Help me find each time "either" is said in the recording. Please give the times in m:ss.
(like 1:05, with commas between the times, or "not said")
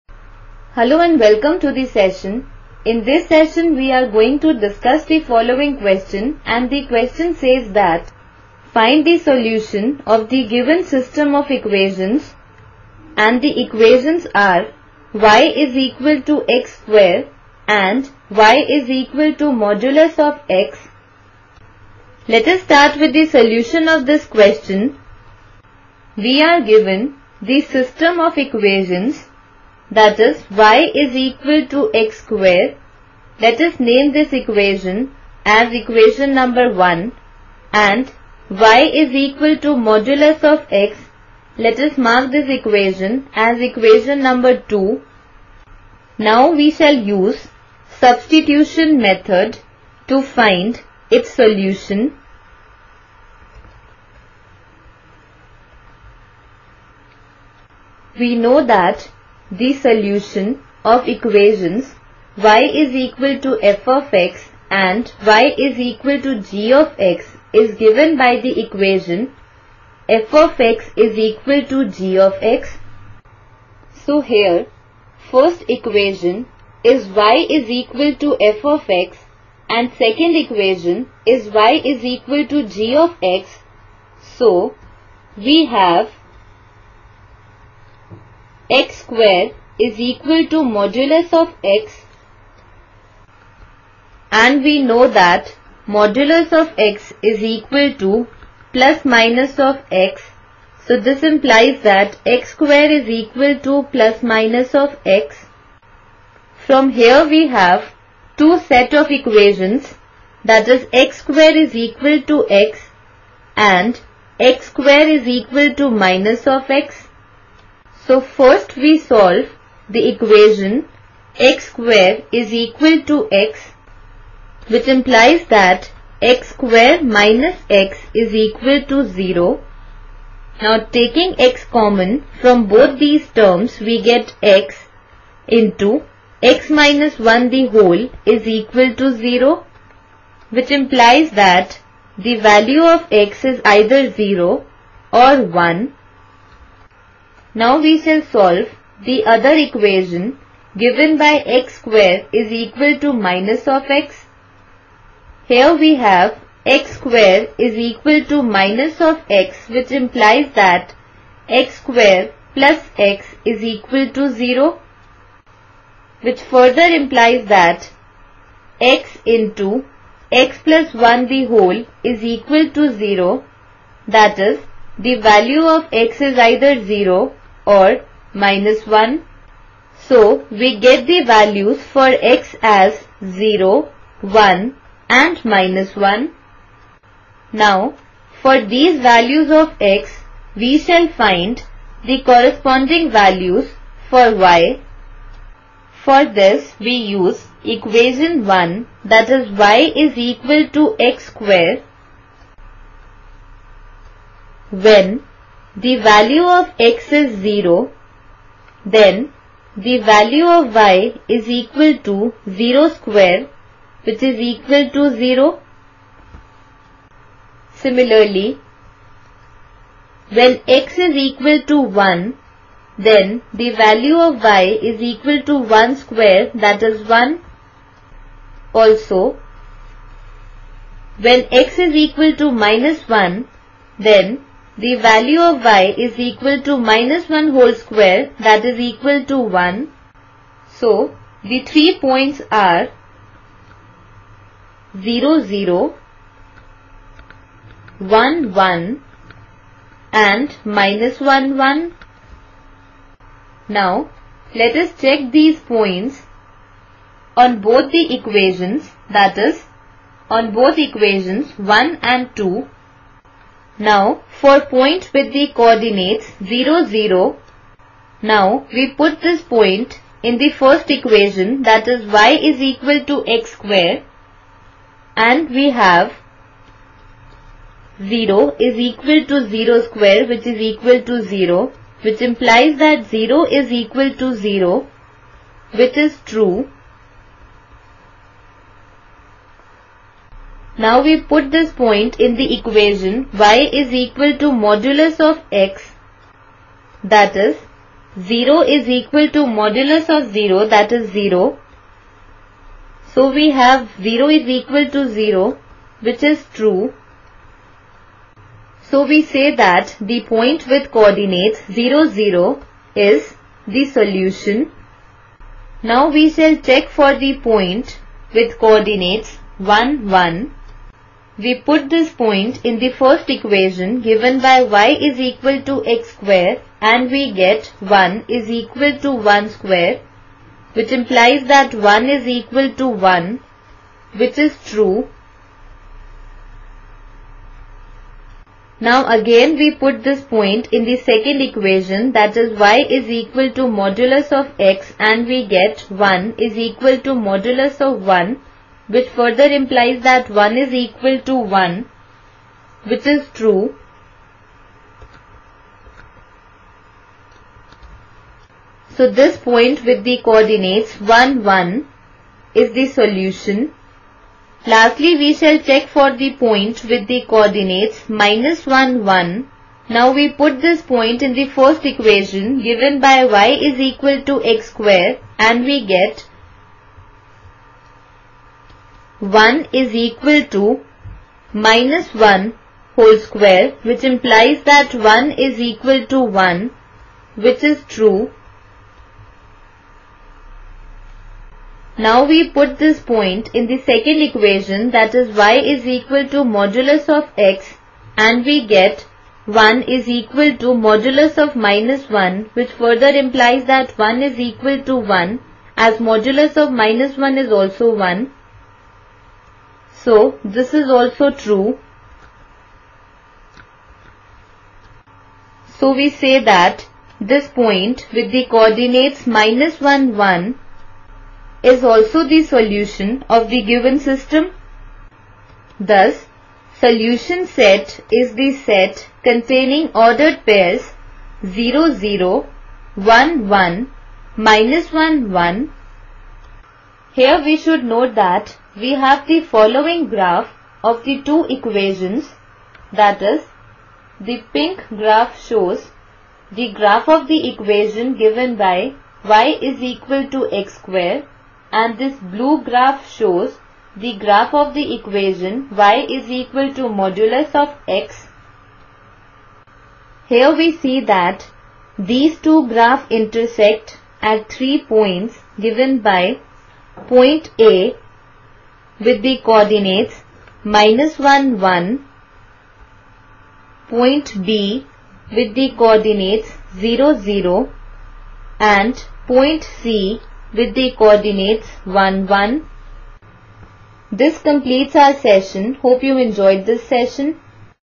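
2:23, 2:56.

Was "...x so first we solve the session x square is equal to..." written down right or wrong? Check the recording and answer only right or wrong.
wrong.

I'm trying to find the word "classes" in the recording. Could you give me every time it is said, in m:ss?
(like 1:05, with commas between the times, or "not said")
not said.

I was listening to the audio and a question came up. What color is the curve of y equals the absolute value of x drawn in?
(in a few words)
Blue.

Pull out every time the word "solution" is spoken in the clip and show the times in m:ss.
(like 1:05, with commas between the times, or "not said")
0:09, 0:23, 0:51, 0:59, 5:13, 6:02, 7:02, 7:06.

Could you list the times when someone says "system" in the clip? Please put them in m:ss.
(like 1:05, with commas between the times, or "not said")
0:10, 0:27, 7:03.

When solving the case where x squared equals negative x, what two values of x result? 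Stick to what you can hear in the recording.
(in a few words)
0 or -1.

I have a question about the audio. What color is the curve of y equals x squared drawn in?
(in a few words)
Pink.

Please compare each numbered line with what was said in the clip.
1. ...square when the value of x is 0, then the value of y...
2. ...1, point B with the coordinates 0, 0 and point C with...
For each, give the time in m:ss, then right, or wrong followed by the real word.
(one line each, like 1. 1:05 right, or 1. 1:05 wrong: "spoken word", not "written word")
1. 3:21 right
2. 7:51 right.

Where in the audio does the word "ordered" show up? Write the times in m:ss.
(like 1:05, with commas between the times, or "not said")
7:09.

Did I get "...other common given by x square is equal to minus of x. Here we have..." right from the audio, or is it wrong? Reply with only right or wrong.
wrong.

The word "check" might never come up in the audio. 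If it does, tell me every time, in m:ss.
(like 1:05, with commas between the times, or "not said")
4:15, 5:16, 6:05.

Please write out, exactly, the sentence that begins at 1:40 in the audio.
So this implies that x square is equal to plus minus of x.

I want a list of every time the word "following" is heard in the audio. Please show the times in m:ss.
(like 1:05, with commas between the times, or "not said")
0:05, 7:19.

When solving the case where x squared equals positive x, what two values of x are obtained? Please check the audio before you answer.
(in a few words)
0 or 1.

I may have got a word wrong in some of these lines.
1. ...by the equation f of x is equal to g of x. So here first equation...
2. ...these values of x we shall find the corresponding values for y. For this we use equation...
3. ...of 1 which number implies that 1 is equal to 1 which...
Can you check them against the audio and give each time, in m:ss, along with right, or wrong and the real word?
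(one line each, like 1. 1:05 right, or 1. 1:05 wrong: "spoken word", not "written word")
1. 1:08 right
2. 3:08 right
3. 5:47 wrong: "further", not "number".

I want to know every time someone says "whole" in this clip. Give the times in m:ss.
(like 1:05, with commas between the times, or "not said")
2:17, 2:51, 3:57, 6:22.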